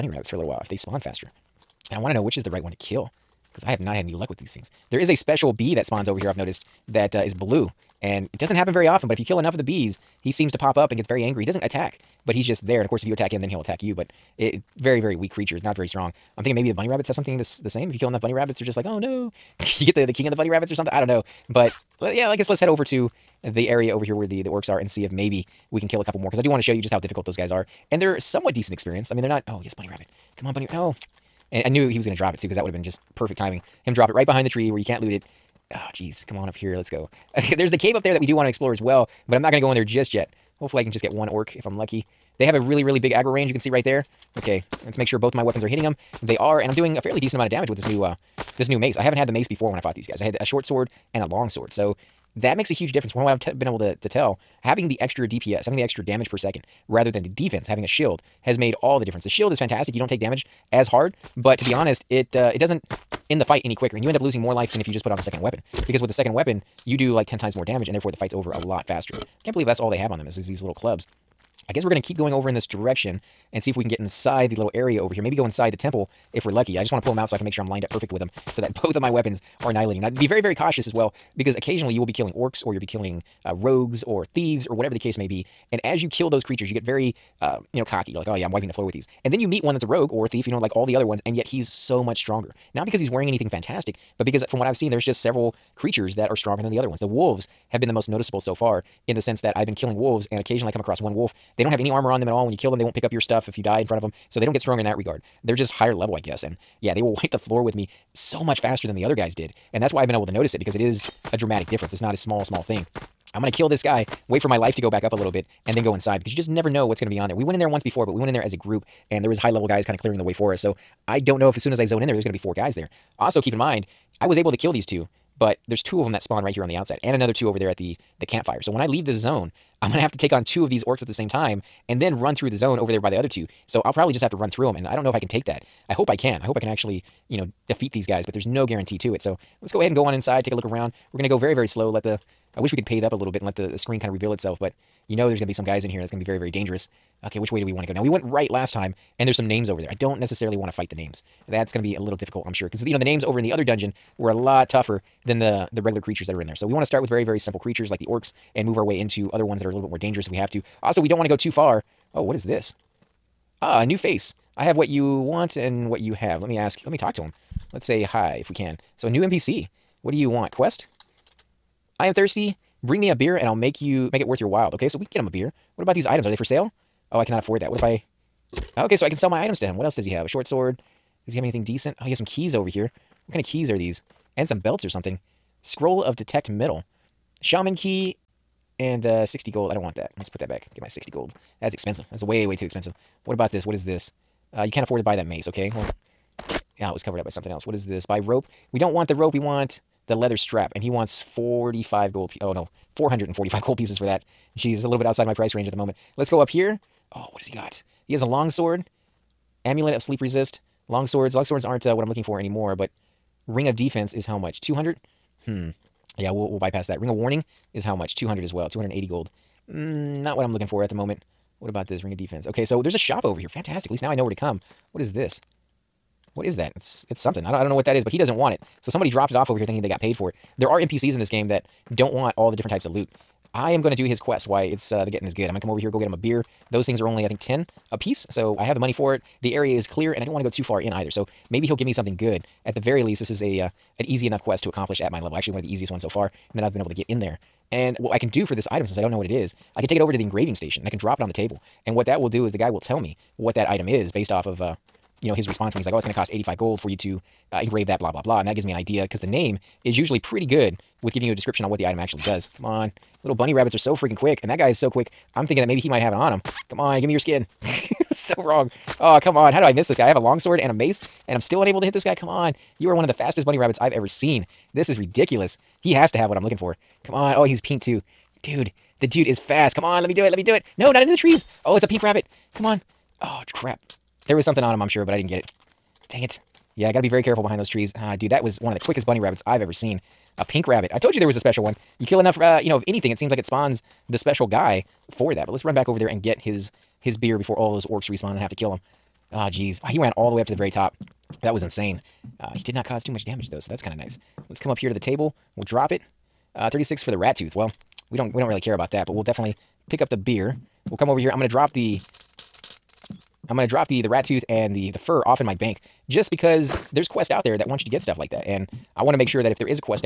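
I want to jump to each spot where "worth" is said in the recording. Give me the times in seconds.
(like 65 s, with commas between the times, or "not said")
174 s.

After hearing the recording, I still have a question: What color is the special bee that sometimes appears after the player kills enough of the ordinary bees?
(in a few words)
Blue.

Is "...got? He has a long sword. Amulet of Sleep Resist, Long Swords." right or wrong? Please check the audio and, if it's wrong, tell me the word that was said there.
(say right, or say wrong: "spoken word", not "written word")
right.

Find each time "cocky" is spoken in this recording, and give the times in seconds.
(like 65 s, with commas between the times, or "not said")
87 s.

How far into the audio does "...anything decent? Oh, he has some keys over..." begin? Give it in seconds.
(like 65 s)
181 s.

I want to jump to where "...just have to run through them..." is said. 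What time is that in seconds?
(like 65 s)
134 s.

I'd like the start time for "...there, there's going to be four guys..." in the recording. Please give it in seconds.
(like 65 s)
122 s.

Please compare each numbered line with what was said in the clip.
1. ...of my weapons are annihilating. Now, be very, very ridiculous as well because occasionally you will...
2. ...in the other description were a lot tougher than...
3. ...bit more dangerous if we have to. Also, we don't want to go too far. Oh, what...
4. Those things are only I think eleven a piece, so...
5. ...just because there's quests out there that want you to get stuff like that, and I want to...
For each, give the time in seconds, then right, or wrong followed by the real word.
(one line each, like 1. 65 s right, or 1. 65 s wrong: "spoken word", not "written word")
1. 78 s wrong: "cautious", not "ridiculous"
2. 153 s wrong: "dungeon", not "description"
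3. 159 s right
4. 236 s wrong: "ten", not "eleven"
5. 316 s right.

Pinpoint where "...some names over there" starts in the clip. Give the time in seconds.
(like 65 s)
149 s.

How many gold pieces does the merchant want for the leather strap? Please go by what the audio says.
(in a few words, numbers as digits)
445.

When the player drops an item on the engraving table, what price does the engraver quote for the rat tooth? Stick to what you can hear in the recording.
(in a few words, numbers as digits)
36 gold.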